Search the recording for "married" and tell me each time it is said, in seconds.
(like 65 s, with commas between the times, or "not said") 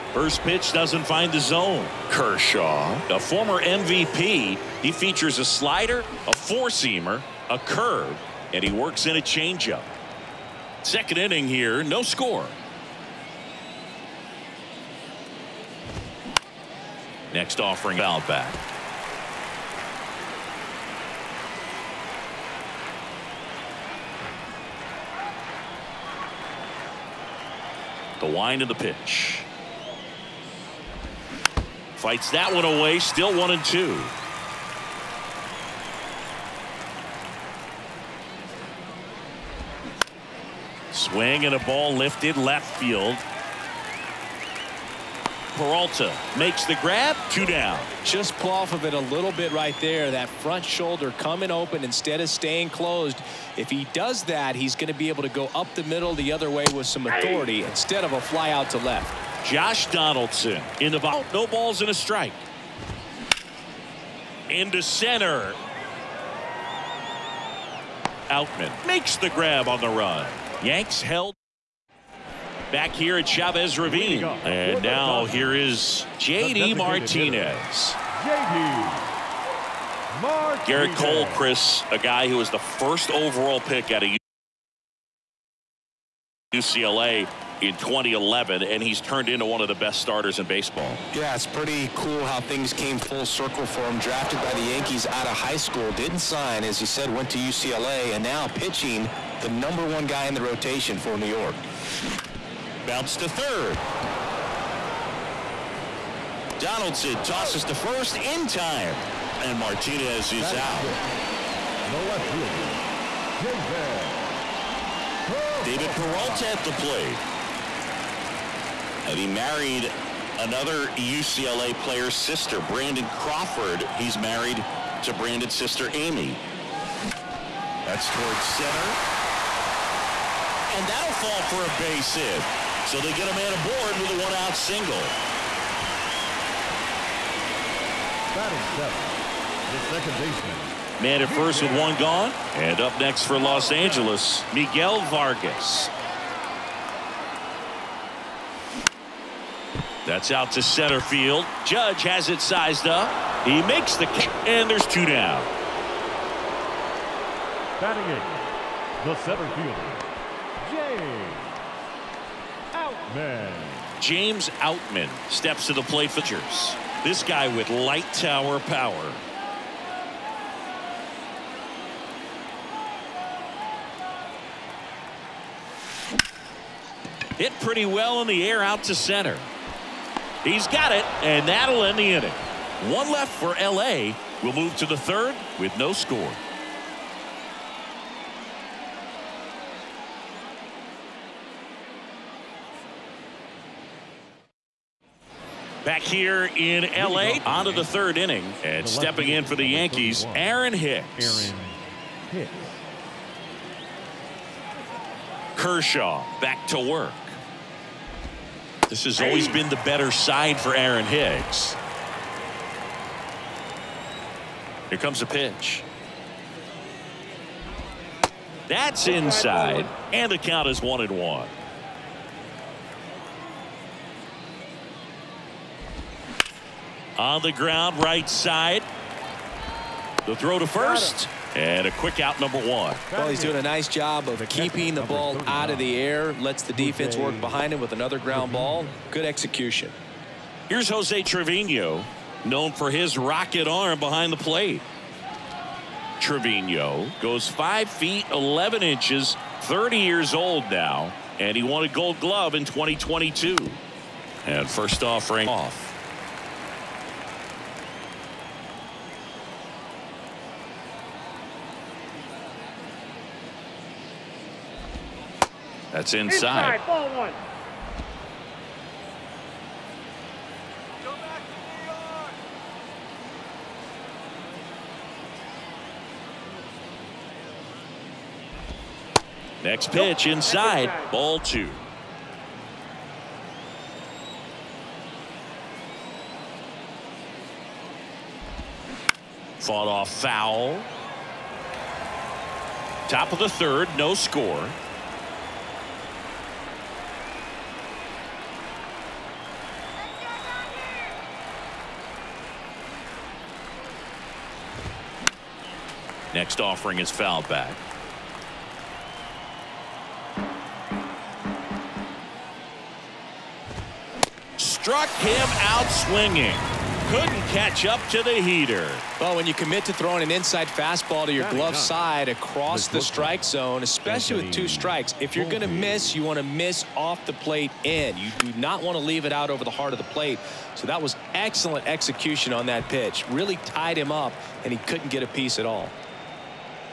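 119 s, 124 s.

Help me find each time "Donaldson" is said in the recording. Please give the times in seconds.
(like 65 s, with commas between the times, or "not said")
59 s, 106 s.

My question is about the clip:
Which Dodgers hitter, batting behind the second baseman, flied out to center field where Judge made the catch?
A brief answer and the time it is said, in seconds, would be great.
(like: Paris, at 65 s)
Miguel Vargas, at 144 s.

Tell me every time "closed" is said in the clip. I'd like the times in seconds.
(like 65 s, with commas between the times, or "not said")
52 s.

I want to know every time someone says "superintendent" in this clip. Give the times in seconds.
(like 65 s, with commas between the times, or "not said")
not said.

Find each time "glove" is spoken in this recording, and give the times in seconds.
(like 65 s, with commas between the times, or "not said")
252 s, 321 s.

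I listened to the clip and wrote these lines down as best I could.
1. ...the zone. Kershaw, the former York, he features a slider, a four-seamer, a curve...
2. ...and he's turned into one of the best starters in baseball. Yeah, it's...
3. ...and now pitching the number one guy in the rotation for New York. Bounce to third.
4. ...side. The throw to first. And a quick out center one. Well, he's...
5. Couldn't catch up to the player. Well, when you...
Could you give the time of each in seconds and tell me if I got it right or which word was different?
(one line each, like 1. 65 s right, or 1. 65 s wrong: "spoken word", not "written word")
1. 1 s wrong: "MVP", not "York"
2. 88 s right
3. 98 s right
4. 228 s wrong: "number", not "center"
5. 317 s wrong: "heater", not "player".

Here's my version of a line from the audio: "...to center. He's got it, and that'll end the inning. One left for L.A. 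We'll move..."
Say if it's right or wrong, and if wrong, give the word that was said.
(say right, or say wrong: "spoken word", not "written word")
right.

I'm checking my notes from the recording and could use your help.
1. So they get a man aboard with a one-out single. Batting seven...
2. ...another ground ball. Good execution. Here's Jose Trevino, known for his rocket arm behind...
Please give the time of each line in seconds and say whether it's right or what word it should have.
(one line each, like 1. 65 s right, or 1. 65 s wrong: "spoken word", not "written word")
1. 132 s right
2. 237 s right.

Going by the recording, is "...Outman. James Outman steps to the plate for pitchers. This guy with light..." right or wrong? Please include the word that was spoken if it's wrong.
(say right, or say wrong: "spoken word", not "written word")
right.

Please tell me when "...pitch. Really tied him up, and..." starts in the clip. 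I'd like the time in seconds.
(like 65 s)
332 s.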